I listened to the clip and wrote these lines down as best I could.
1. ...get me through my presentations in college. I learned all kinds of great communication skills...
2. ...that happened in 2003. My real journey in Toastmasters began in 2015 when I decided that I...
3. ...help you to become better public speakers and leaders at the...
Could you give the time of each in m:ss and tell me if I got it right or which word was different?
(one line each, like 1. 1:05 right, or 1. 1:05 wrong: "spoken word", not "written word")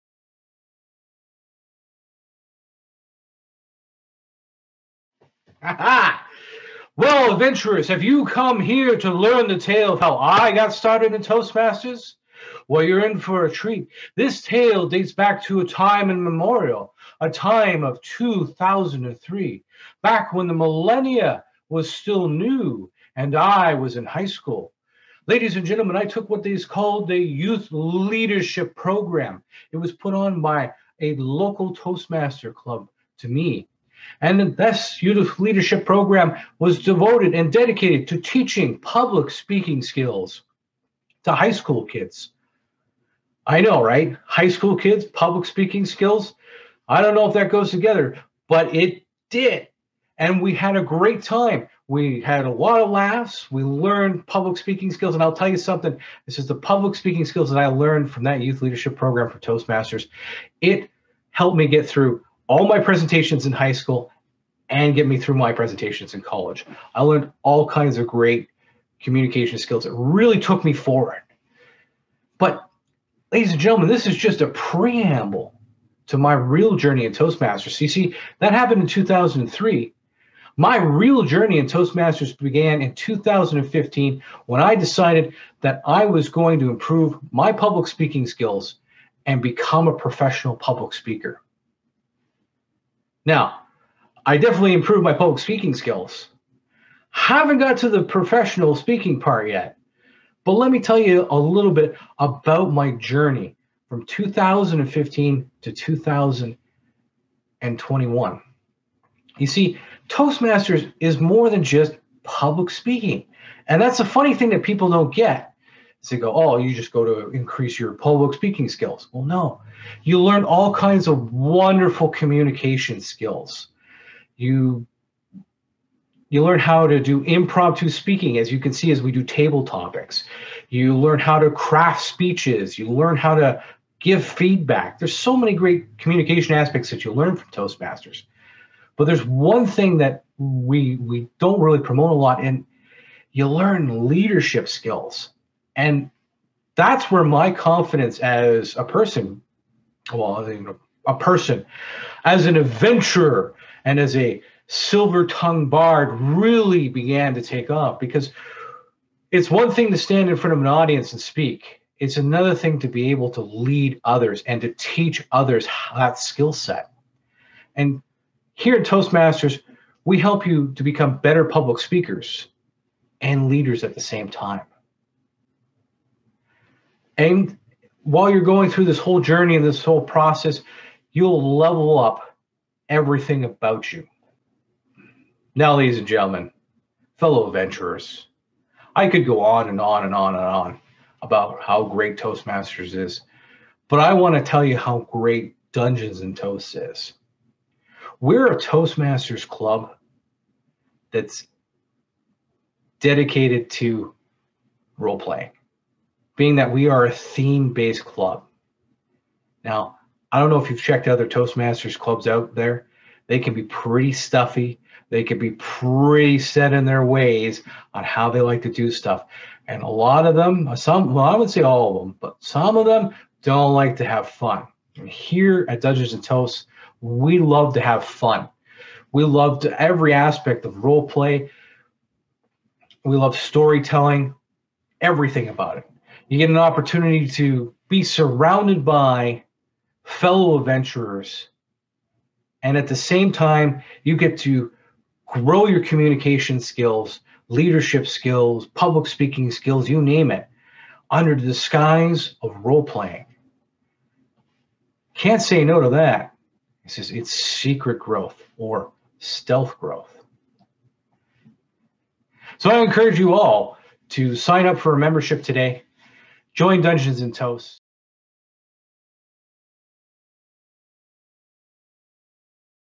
1. 1:04 right
2. 1:18 right
3. 2:50 right.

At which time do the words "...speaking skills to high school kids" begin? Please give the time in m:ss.
0:39.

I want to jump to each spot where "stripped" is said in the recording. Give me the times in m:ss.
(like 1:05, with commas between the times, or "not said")
not said.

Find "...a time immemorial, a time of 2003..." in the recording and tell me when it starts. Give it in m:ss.
0:15.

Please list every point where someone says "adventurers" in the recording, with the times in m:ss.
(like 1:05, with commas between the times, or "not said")
0:07, 2:32, 3:07, 4:00.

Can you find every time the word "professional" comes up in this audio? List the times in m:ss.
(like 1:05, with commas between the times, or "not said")
1:29, 1:38.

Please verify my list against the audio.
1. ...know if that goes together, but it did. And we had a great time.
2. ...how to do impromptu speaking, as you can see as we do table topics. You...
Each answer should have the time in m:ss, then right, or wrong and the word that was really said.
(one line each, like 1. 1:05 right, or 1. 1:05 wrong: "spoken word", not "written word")
1. 0:47 right
2. 2:06 right.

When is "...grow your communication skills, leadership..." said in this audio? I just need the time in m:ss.
4:05.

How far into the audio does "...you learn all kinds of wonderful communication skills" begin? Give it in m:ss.
2:00.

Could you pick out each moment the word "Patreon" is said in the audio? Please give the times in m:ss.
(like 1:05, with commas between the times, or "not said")
not said.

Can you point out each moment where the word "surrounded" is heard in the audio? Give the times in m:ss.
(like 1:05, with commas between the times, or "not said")
3:58.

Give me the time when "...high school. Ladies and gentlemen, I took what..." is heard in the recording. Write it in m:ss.
0:24.